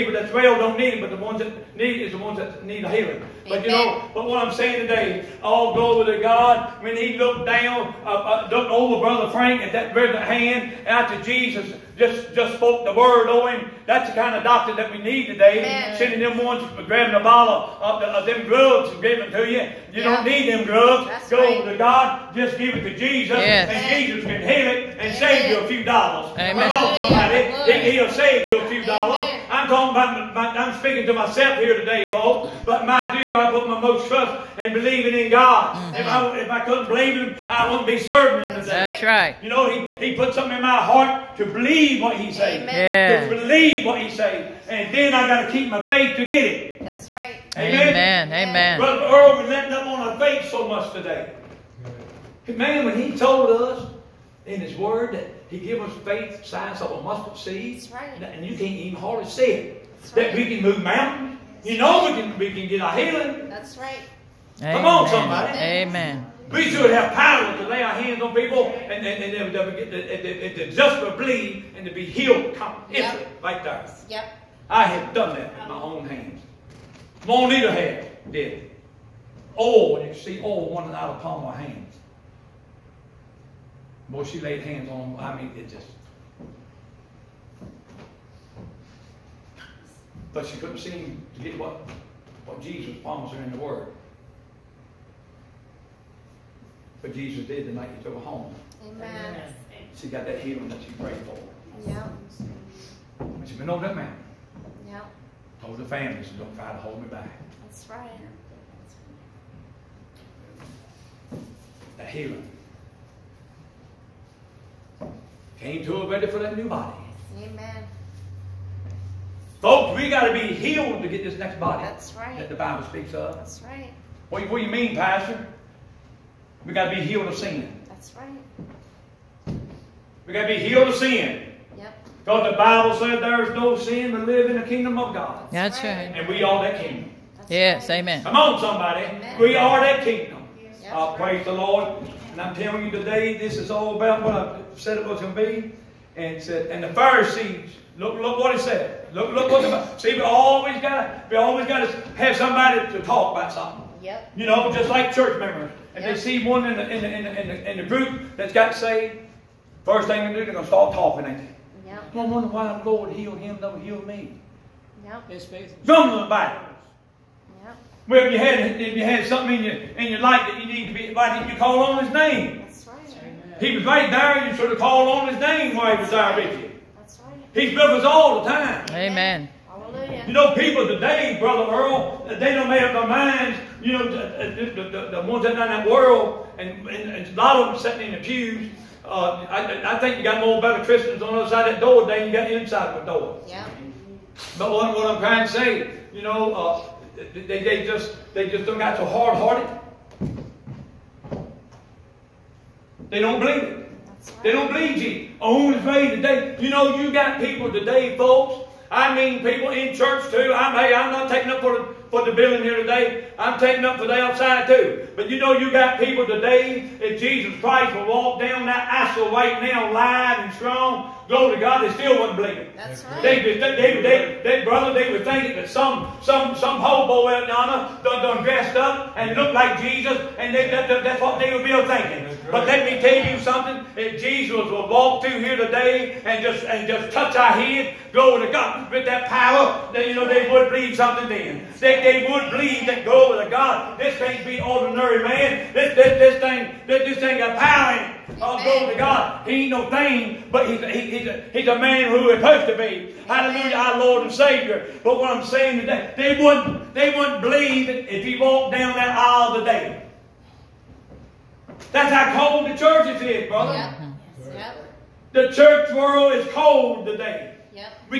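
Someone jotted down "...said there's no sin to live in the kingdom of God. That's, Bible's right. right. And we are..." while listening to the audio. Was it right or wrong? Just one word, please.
wrong.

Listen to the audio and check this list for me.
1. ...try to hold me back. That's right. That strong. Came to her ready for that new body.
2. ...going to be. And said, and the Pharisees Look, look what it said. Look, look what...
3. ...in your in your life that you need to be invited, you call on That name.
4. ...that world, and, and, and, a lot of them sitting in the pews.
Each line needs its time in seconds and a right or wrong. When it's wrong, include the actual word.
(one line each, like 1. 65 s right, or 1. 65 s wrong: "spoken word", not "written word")
1. 106 s wrong: "healing", not "strong"
2. 145 s right
3. 169 s wrong: "His", not "That"
4. 185 s right.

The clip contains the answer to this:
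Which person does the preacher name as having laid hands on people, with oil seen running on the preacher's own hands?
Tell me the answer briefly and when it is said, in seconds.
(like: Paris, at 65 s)
Monita, at 77 s.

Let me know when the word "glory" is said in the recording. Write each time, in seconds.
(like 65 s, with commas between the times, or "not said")
5 s, 221 s, 238 s, 243 s, 248 s.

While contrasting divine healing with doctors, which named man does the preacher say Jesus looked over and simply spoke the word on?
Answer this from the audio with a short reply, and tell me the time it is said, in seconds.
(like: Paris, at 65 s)
Brother Frank, at 8 s.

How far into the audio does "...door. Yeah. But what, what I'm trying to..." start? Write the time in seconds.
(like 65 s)
193 s.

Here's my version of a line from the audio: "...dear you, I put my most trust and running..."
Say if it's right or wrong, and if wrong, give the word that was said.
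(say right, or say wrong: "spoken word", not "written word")
wrong: "believing", not "running".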